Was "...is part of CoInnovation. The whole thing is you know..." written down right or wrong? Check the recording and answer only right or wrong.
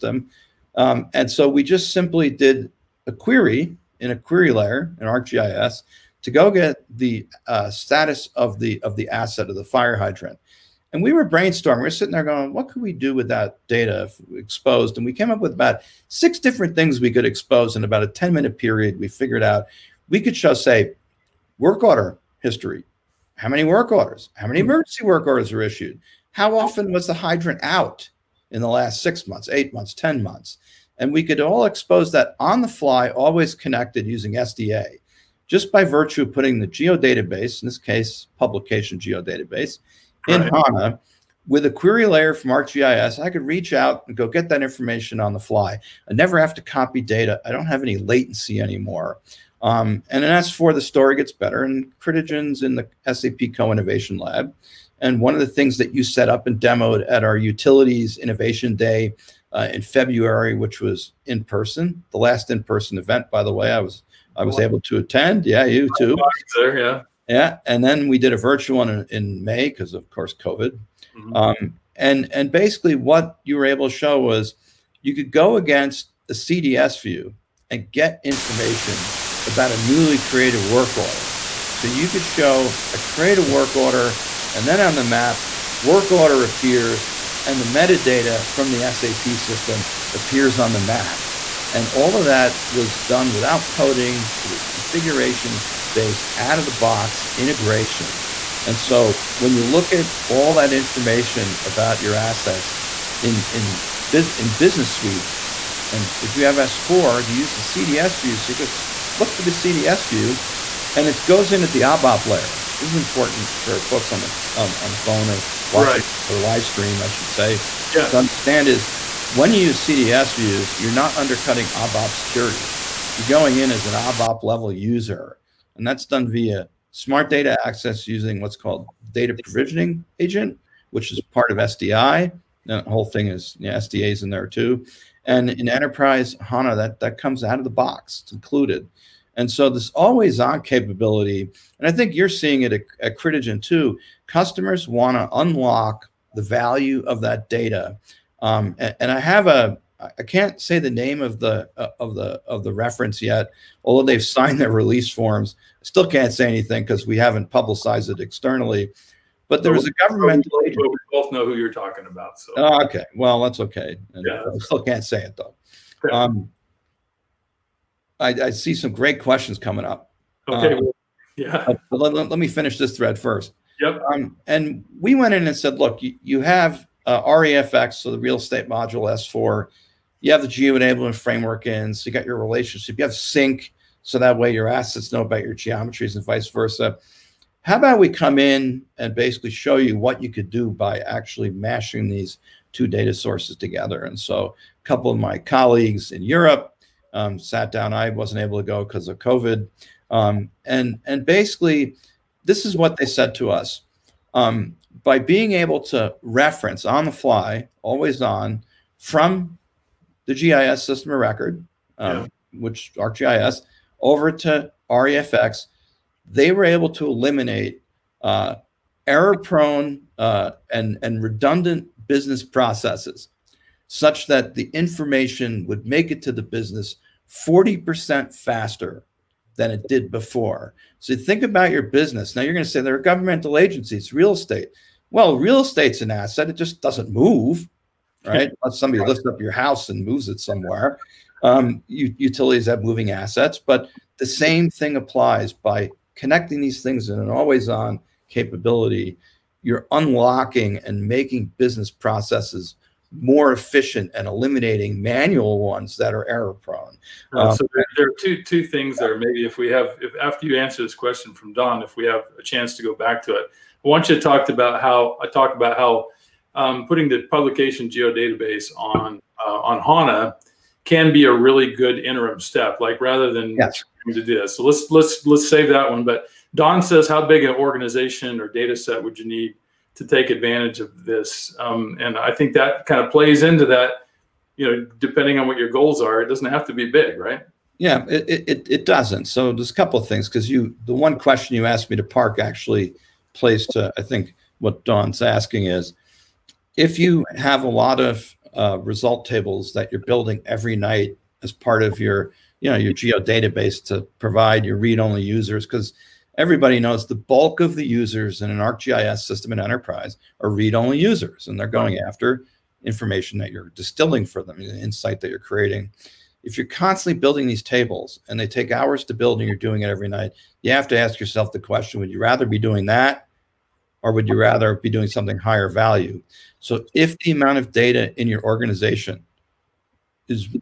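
wrong.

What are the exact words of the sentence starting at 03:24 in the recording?
Um, by being able to reference on the fly, always on, from the GIS system of record, um, yeah.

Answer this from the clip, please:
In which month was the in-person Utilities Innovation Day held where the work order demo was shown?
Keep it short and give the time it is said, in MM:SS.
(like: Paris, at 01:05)
February, at 00:59.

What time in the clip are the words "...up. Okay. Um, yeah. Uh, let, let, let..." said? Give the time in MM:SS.
02:49.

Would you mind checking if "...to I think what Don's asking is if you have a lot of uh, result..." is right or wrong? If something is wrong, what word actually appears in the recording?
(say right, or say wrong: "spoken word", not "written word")
right.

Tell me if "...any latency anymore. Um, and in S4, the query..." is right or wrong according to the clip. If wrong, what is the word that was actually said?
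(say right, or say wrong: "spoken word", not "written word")
wrong: "story", not "query".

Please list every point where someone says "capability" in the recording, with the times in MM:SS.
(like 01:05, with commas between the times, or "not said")
02:20, 04:08.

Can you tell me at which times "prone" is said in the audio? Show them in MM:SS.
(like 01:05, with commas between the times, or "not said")
03:39, 04:16.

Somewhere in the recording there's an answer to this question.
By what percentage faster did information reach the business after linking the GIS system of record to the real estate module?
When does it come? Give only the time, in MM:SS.
03:47.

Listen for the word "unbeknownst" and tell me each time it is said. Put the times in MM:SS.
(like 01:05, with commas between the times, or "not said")
not said.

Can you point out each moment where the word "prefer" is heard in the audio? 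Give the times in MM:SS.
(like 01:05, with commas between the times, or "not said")
not said.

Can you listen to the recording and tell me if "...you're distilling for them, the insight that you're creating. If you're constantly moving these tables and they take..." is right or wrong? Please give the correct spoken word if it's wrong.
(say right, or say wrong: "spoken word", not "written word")
wrong: "building", not "moving".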